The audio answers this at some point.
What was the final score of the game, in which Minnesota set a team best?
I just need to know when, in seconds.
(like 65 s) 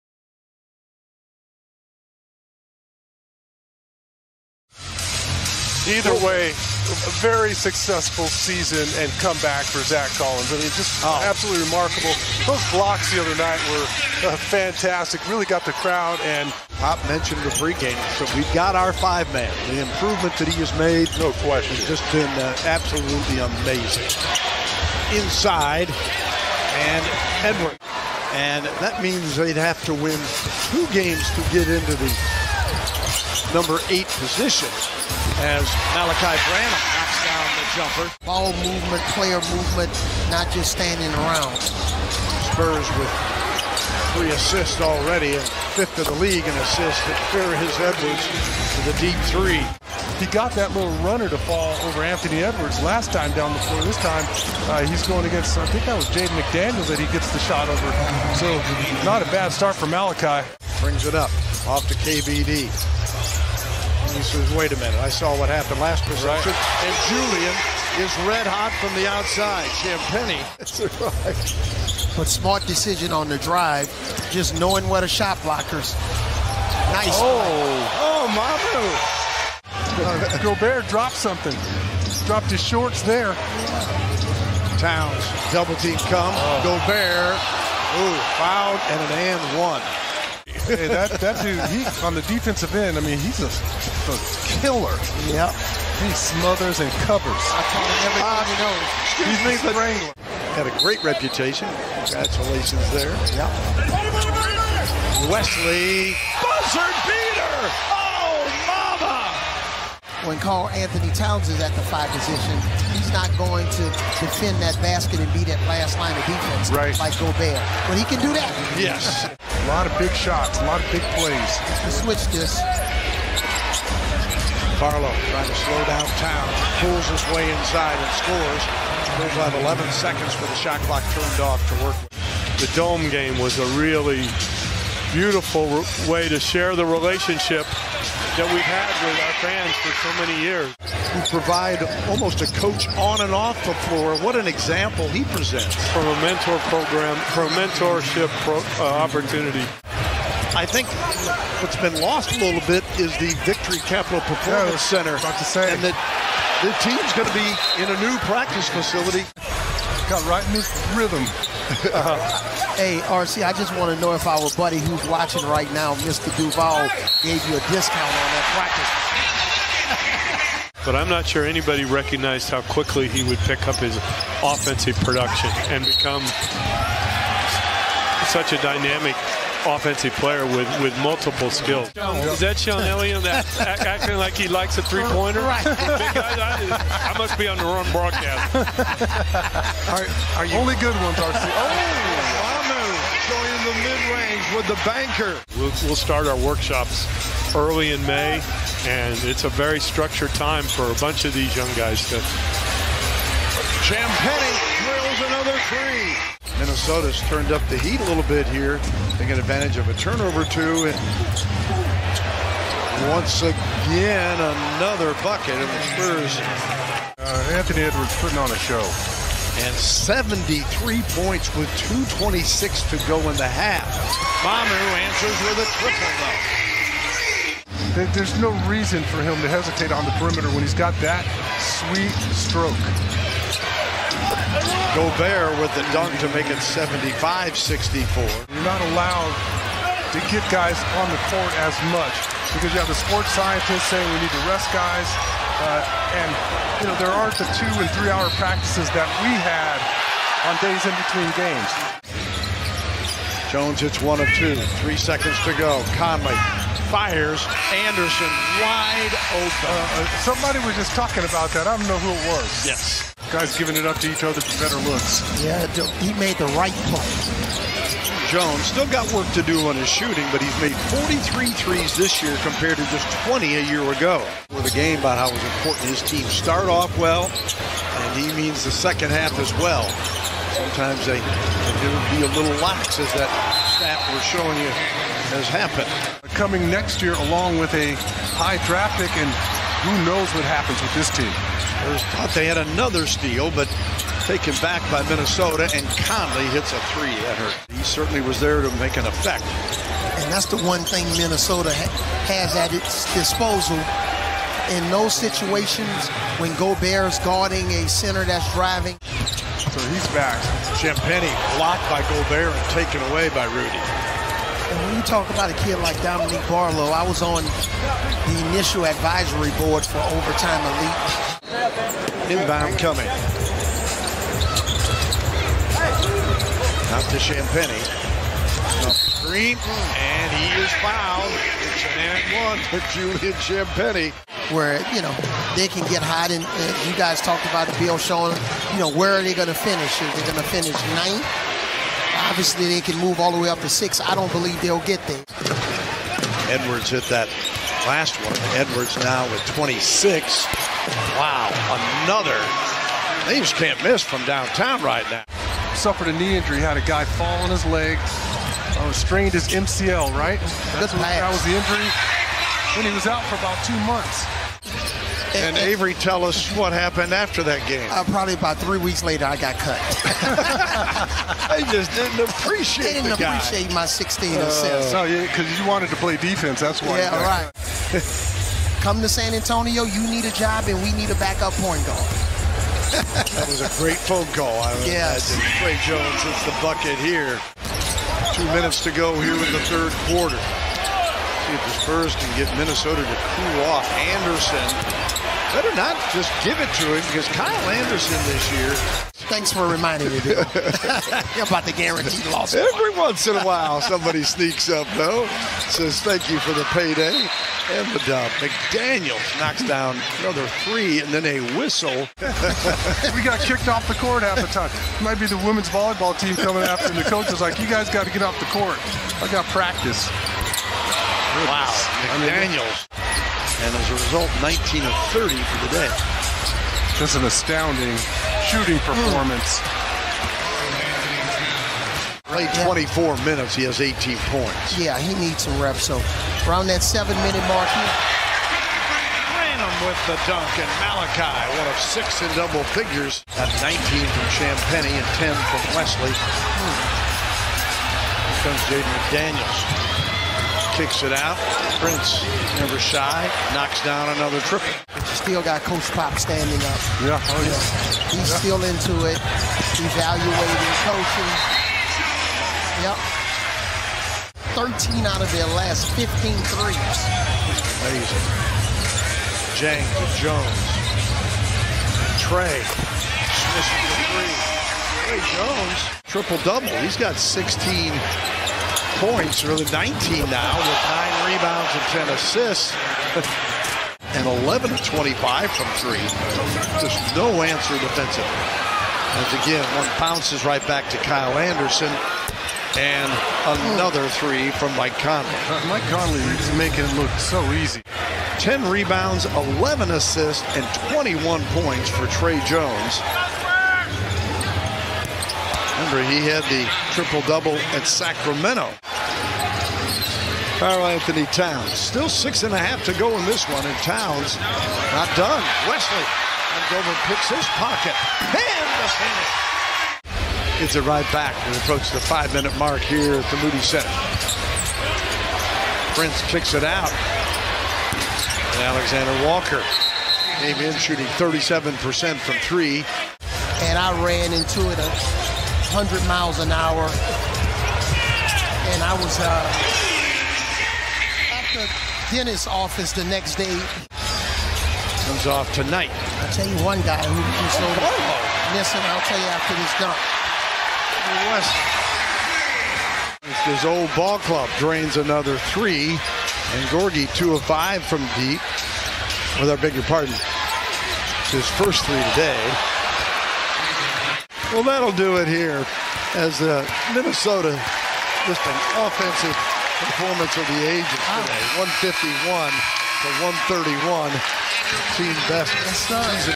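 571 s.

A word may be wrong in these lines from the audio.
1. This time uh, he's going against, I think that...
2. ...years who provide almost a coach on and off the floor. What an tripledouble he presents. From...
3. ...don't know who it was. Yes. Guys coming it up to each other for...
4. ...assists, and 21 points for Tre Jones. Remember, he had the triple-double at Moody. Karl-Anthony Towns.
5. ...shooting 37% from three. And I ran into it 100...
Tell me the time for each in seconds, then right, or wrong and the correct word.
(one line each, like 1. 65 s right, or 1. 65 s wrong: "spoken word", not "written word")
1. 53 s right
2. 140 s wrong: "example", not "tripledouble"
3. 261 s wrong: "giving", not "coming"
4. 499 s wrong: "Sacramento", not "Moody"
5. 530 s right.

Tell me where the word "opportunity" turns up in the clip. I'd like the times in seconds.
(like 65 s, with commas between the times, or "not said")
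149 s.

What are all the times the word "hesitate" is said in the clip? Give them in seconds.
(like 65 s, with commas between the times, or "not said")
229 s.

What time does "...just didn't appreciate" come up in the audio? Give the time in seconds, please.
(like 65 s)
371 s.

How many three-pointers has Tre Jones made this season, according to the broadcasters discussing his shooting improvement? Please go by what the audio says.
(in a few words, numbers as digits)
43.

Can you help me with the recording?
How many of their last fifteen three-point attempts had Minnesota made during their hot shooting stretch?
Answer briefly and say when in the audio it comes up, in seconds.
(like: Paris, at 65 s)
13, at 464 s.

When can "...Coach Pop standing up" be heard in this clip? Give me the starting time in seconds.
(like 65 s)
455 s.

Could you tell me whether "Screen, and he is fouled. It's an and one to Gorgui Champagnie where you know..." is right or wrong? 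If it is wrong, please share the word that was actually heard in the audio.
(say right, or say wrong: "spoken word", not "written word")
wrong: "Julian", not "Gorgui".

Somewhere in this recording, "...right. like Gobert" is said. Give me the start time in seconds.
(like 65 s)
116 s.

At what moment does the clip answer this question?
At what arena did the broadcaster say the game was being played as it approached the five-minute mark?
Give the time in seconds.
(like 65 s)
523 s.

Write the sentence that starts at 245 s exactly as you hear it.
Uh, and, you know, there aren't the two and three hour practices that we had on days in between games.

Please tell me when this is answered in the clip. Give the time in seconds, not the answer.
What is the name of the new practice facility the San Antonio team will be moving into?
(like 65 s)
153 s.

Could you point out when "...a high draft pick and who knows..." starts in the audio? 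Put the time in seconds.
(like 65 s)
287 s.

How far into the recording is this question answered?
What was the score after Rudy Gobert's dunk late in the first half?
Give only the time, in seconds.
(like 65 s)
236 s.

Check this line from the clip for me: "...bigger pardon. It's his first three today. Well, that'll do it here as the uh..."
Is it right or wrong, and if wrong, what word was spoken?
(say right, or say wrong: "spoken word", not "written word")
right.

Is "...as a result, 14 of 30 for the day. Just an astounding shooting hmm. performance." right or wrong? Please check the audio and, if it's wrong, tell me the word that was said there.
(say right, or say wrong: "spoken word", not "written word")
wrong: "19", not "14".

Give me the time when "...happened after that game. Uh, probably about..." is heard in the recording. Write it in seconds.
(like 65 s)
366 s.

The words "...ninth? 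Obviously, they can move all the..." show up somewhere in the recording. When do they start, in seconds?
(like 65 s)
340 s.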